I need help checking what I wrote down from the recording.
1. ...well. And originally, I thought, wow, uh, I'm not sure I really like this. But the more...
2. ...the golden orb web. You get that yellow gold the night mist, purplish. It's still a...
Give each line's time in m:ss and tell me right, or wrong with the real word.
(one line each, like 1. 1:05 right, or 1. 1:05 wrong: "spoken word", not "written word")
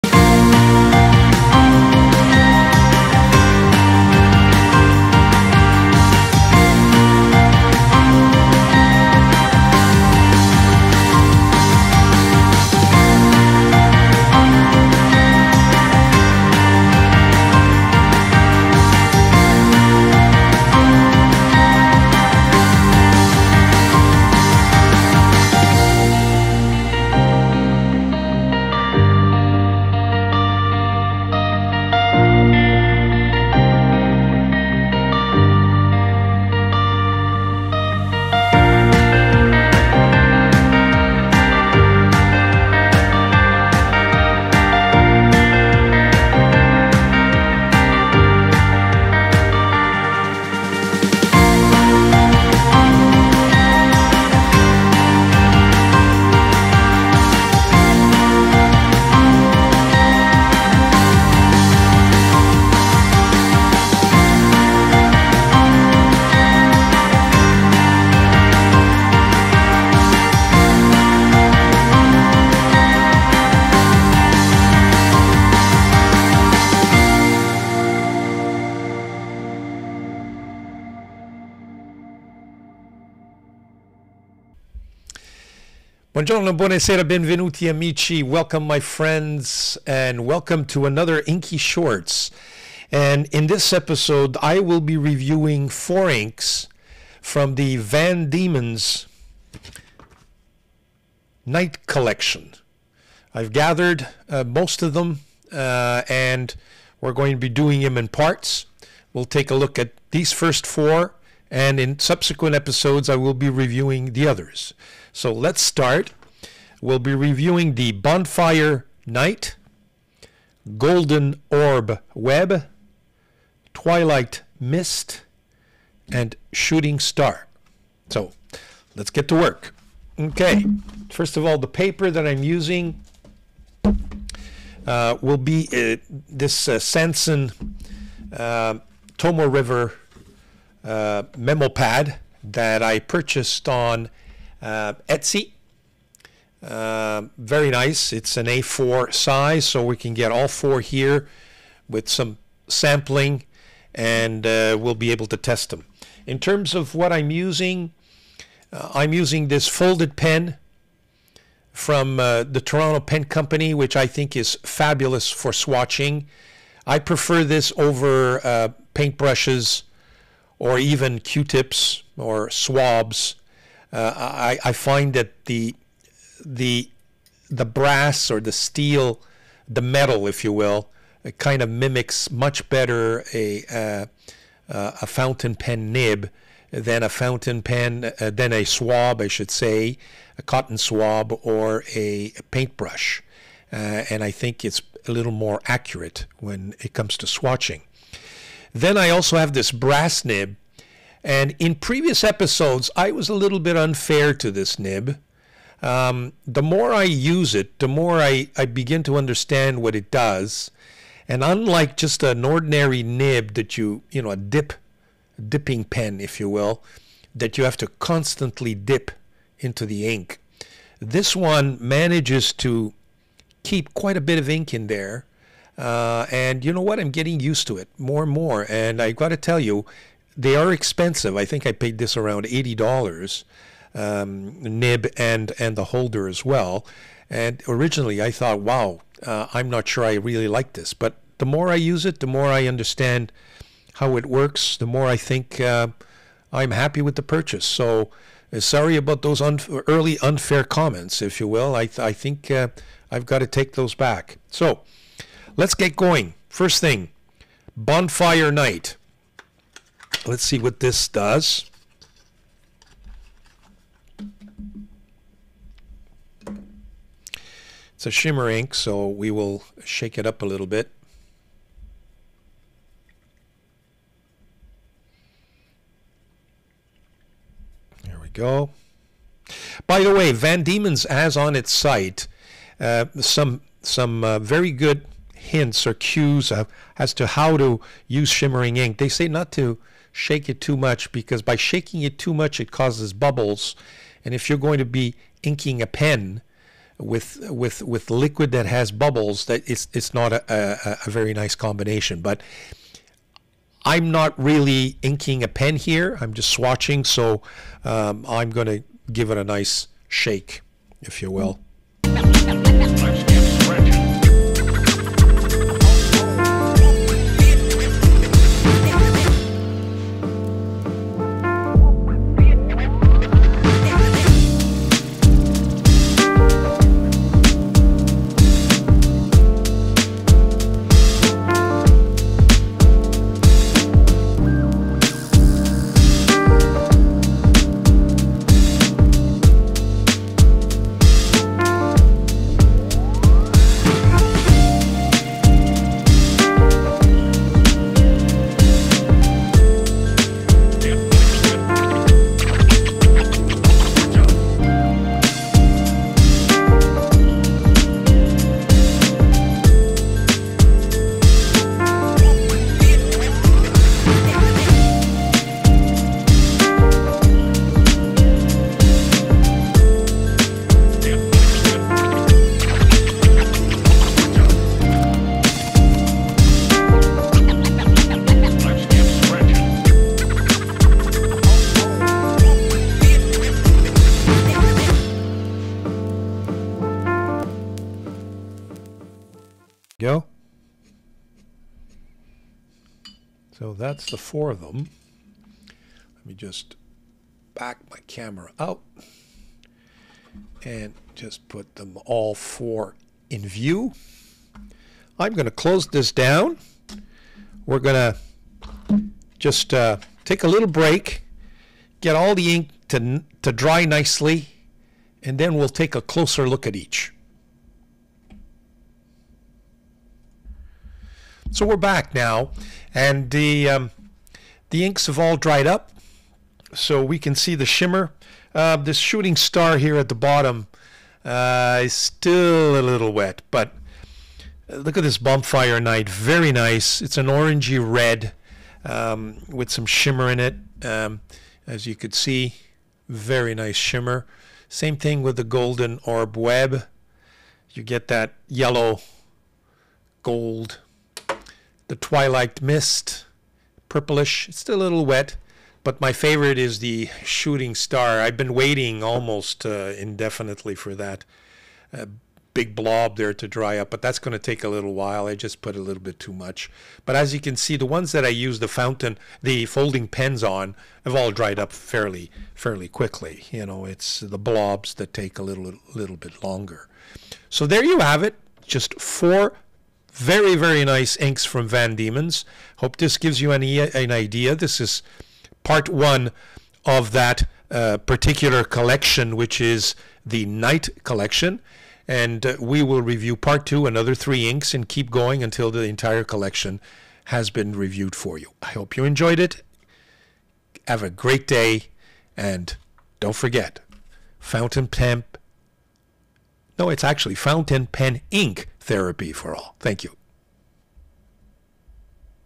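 1. 3:56 right
2. 7:25 wrong: "twilight", not "night".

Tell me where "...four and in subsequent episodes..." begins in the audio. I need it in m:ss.
1:50.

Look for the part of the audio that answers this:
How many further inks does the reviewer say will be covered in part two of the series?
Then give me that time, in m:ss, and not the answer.
8:14.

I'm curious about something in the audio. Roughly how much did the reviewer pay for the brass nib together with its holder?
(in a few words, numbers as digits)
$80.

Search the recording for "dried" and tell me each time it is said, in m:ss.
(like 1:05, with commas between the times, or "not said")
7:05, 7:51.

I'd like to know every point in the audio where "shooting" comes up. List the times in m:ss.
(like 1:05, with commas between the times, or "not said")
2:06, 7:08, 7:37.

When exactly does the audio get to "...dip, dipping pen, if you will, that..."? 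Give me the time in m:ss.
3:34.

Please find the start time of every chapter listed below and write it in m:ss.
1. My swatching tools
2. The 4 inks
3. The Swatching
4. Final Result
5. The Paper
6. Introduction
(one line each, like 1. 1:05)
1. 2:37
2. 1:57
3. 4:17
4. 7:00
5. 2:11
6. 1:25.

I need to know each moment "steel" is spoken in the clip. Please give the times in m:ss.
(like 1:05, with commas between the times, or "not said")
2:58.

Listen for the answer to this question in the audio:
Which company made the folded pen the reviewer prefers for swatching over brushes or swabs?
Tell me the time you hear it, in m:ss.
2:42.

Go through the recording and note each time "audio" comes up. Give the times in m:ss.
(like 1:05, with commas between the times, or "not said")
not said.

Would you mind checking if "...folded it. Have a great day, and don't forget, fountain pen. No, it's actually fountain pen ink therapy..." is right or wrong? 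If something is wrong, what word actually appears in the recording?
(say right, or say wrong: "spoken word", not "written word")
wrong: "enjoyed", not "folded".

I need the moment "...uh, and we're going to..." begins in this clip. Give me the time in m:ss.
1:45.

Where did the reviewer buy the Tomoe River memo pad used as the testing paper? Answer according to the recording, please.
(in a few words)
Etsy.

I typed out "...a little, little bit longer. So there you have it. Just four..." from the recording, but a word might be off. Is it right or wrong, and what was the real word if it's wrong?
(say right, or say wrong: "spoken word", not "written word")
right.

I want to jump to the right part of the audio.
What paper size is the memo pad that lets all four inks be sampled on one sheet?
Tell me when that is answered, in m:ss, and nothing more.
2:28.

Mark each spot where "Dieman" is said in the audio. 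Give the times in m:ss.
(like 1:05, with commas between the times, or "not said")
1:38, 4:40, 8:01.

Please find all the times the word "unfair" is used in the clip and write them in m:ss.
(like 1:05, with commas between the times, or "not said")
3:23, 4:10.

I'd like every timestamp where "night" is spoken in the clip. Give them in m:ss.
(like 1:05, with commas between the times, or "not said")
1:41, 1:59, 4:18, 7:15, 8:10.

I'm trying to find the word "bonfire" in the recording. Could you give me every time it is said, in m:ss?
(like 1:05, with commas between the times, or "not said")
1:57, 4:17, 7:15.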